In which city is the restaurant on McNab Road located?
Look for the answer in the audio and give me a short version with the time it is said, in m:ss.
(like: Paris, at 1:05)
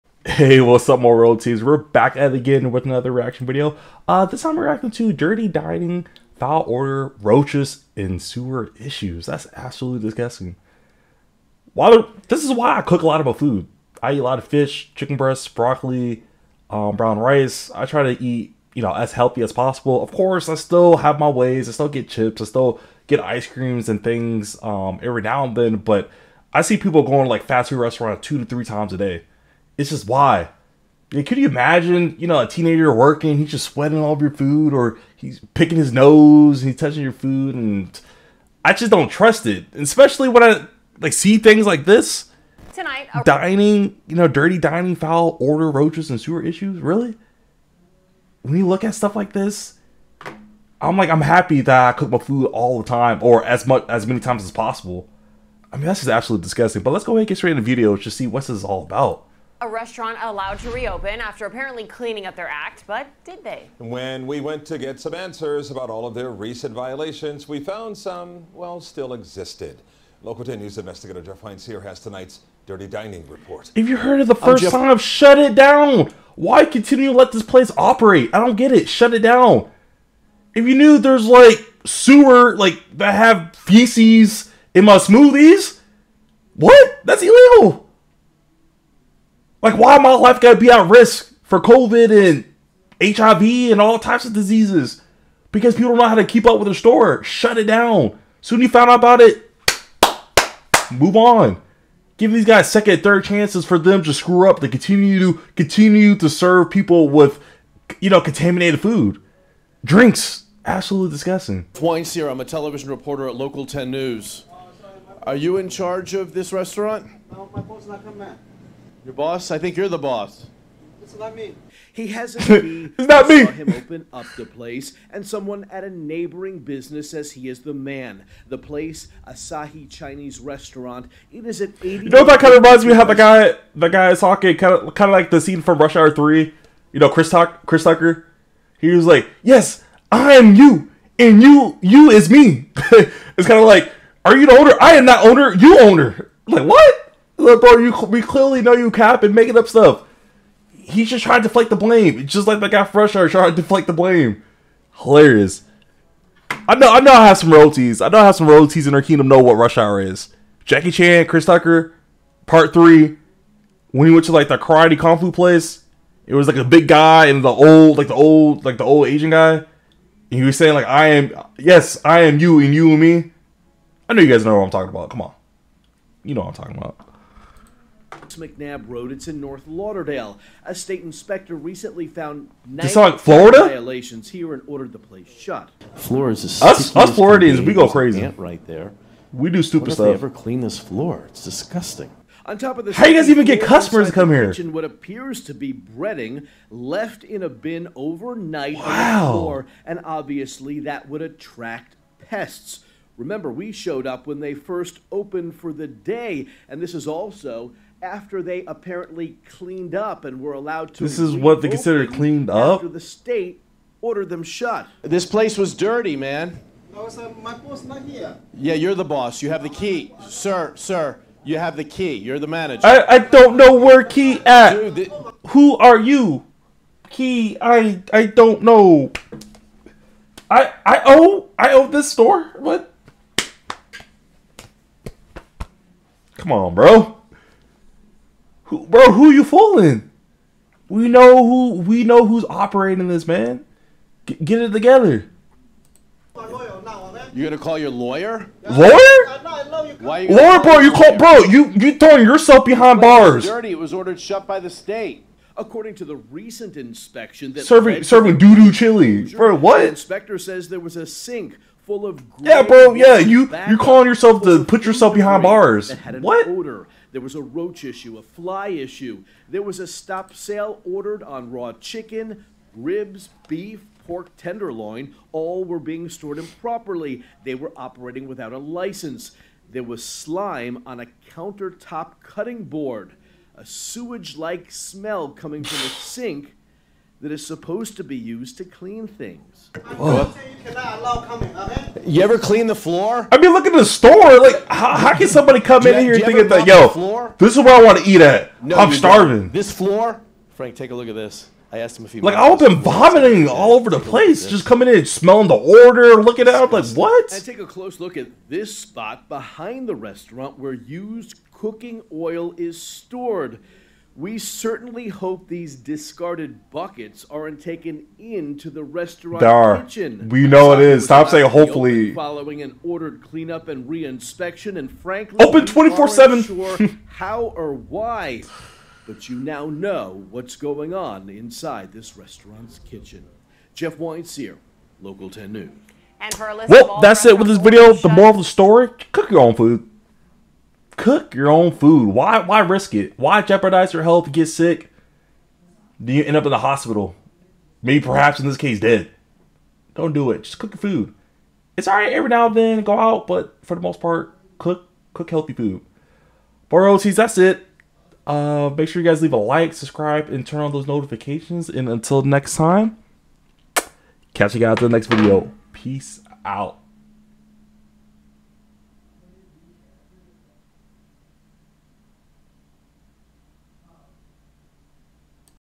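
North Lauderdale, at 2:59.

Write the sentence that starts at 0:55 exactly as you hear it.
I mean, that's just absolutely disgusting.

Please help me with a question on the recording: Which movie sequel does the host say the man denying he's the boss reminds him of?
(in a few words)
Rush Hour 3.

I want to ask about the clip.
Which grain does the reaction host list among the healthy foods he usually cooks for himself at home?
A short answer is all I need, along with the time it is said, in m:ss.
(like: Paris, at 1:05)
brown rice, at 0:16.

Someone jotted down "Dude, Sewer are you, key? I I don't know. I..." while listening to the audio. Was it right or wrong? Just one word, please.
wrong.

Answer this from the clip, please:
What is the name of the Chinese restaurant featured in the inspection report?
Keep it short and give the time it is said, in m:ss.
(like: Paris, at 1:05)
Asahi, at 2:09.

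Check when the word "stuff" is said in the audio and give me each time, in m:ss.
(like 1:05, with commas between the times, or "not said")
0:48, 2:29, 3:09.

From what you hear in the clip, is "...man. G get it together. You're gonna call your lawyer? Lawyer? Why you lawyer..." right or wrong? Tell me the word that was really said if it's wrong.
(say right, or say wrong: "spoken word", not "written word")
right.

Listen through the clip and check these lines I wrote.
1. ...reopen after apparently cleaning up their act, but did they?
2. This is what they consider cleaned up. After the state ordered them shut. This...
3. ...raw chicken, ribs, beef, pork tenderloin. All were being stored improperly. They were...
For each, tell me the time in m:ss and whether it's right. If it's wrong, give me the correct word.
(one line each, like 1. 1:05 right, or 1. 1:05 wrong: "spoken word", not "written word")
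1. 1:00 right
2. 3:31 right
3. 4:31 right.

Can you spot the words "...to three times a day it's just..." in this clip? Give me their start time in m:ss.
0:28.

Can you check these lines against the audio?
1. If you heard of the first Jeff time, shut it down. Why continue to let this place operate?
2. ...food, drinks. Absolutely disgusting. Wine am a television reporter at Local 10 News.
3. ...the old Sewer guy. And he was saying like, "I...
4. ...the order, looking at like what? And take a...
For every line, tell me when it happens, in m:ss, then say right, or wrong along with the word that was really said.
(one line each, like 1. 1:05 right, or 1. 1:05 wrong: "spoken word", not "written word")
1. 1:13 right
2. 1:48 right
3. 2:48 wrong: "Asian", not "Sewer"
4. 5:05 right.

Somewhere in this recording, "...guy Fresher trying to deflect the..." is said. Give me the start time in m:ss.
2:32.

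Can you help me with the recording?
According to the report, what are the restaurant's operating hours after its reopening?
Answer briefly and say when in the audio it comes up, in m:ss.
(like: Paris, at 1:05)
24/7, at 5:25.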